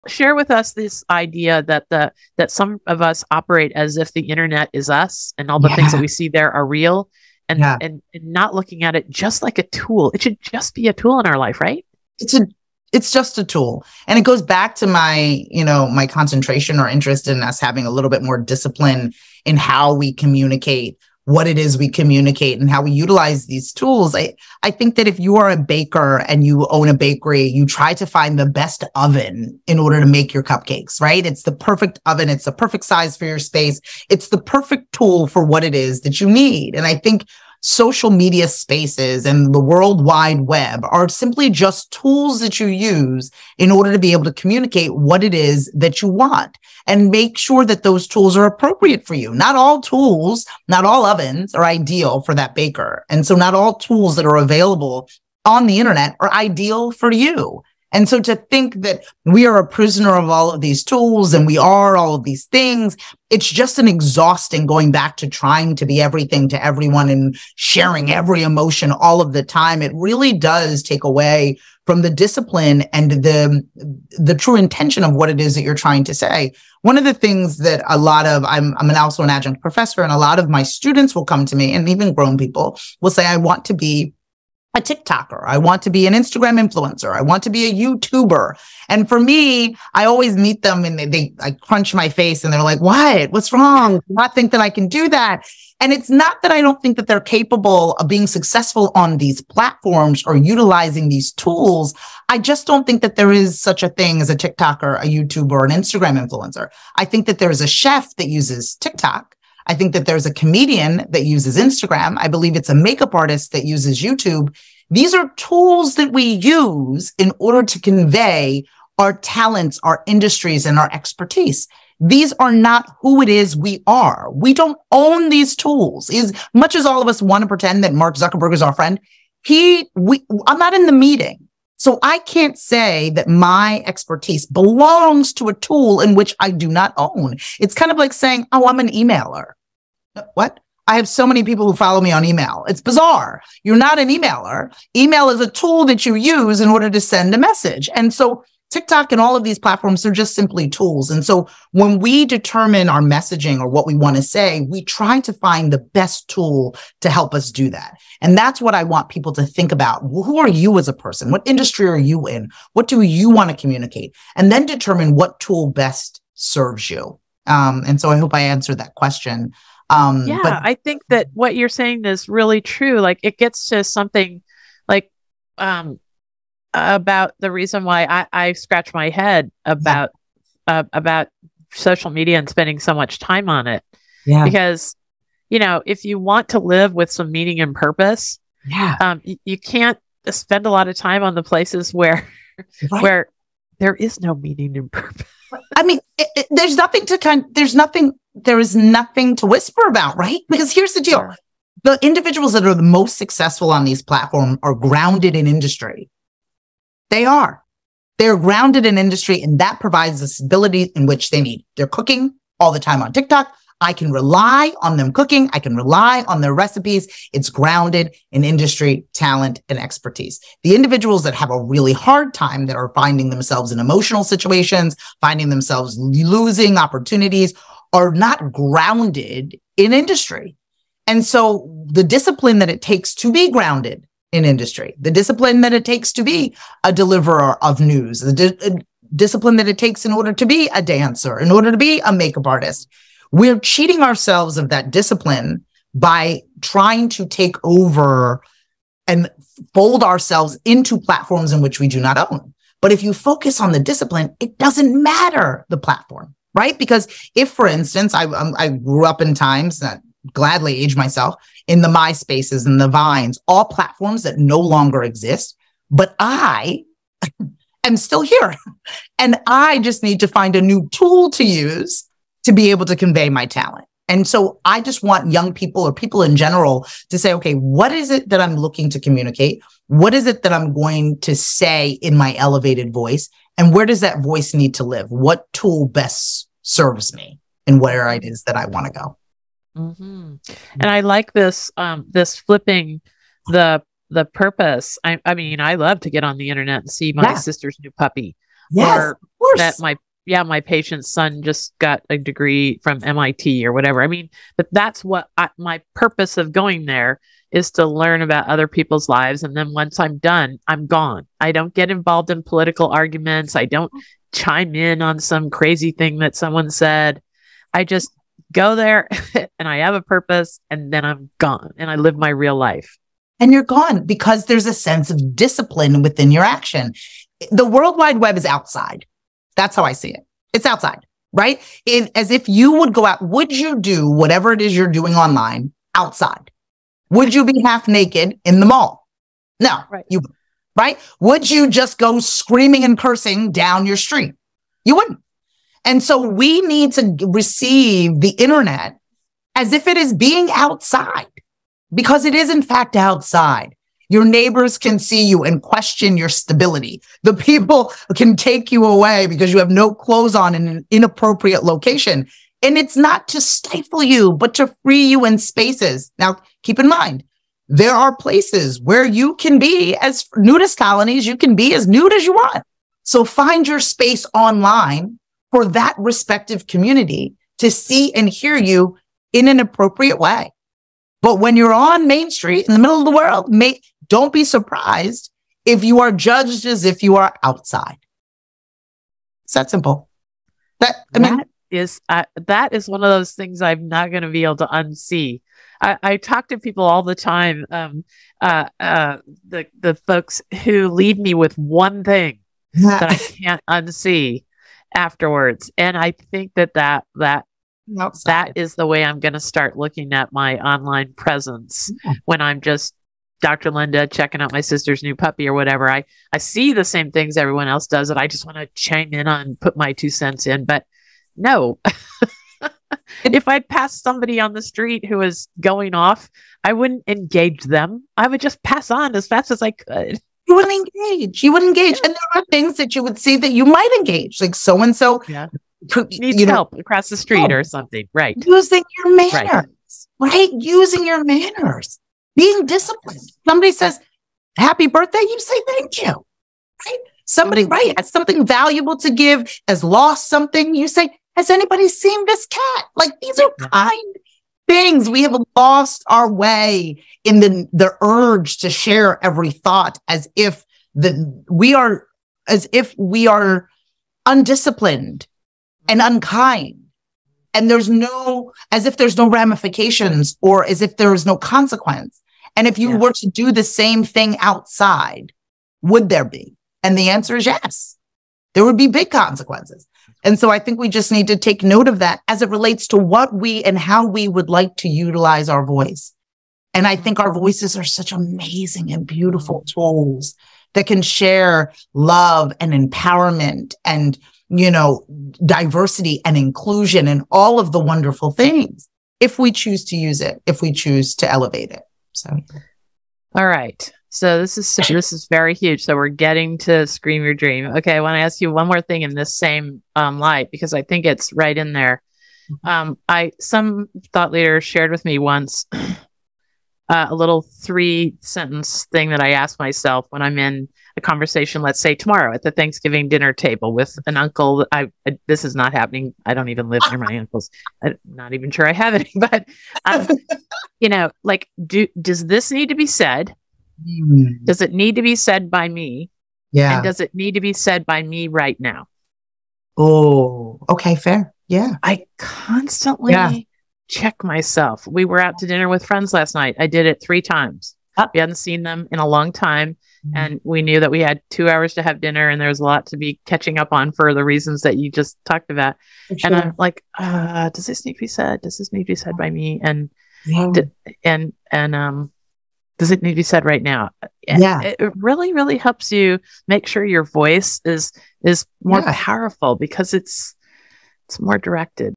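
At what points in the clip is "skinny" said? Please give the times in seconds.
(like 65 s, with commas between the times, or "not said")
not said.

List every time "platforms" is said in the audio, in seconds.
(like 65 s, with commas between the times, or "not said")
99 s, 149 s, 204 s, 250 s, 255 s, 263 s.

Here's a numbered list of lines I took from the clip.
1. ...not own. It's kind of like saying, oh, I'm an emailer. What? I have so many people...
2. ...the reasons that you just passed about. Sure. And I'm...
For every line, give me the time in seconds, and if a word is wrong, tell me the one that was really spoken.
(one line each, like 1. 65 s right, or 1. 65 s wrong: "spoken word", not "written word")
1. 136 s right
2. 554 s wrong: "talked", not "passed".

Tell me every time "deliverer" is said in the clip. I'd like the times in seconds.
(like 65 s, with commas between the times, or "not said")
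236 s.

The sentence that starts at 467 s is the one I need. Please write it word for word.
And there's no, as if there's no ramifications or as if there is no consequence.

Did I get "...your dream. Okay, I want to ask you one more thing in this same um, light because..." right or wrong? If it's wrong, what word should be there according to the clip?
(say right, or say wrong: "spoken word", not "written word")
right.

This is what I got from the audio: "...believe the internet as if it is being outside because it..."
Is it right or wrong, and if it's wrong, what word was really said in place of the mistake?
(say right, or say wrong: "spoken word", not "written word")
wrong: "receive", not "believe".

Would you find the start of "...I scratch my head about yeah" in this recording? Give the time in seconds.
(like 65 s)
178 s.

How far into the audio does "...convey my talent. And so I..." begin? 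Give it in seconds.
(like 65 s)
272 s.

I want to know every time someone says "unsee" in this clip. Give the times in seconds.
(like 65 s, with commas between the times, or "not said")
394 s, 403 s.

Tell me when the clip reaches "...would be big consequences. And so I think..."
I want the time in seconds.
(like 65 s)
478 s.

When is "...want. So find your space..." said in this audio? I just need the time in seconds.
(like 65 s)
372 s.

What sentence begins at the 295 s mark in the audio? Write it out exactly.
I, I, mean, I love to get on the internet and see my yeah.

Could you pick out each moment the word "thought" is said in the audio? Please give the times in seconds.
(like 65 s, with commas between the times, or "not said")
459 s, 514 s.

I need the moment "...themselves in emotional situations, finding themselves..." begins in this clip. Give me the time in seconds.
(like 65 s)
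223 s.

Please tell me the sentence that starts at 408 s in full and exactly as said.
that is the way I'm going to start looking at my online presence yeah.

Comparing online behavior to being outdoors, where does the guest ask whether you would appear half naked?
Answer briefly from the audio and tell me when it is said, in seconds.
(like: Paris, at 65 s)
The mall, at 338 s.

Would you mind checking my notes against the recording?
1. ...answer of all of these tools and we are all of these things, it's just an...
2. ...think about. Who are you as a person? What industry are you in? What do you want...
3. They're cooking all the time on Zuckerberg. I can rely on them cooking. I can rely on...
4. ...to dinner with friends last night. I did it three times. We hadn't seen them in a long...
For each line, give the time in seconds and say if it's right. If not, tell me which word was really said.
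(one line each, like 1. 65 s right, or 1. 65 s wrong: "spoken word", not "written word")
1. 59 s wrong: "prisoner", not "answer"
2. 159 s right
3. 211 s wrong: "TikTok", not "Zuckerberg"
4. 545 s right.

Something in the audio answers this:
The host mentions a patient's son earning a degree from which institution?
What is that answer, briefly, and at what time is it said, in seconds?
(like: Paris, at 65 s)
MIT, at 303 s.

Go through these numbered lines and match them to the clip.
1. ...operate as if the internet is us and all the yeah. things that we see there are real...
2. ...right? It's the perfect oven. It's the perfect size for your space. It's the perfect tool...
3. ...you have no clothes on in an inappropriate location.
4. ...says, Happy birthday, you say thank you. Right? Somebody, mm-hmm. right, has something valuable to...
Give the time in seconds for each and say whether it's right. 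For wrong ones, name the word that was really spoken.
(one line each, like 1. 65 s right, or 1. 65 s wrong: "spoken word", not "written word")
1. 3 s right
2. 30 s right
3. 359 s right
4. 443 s right.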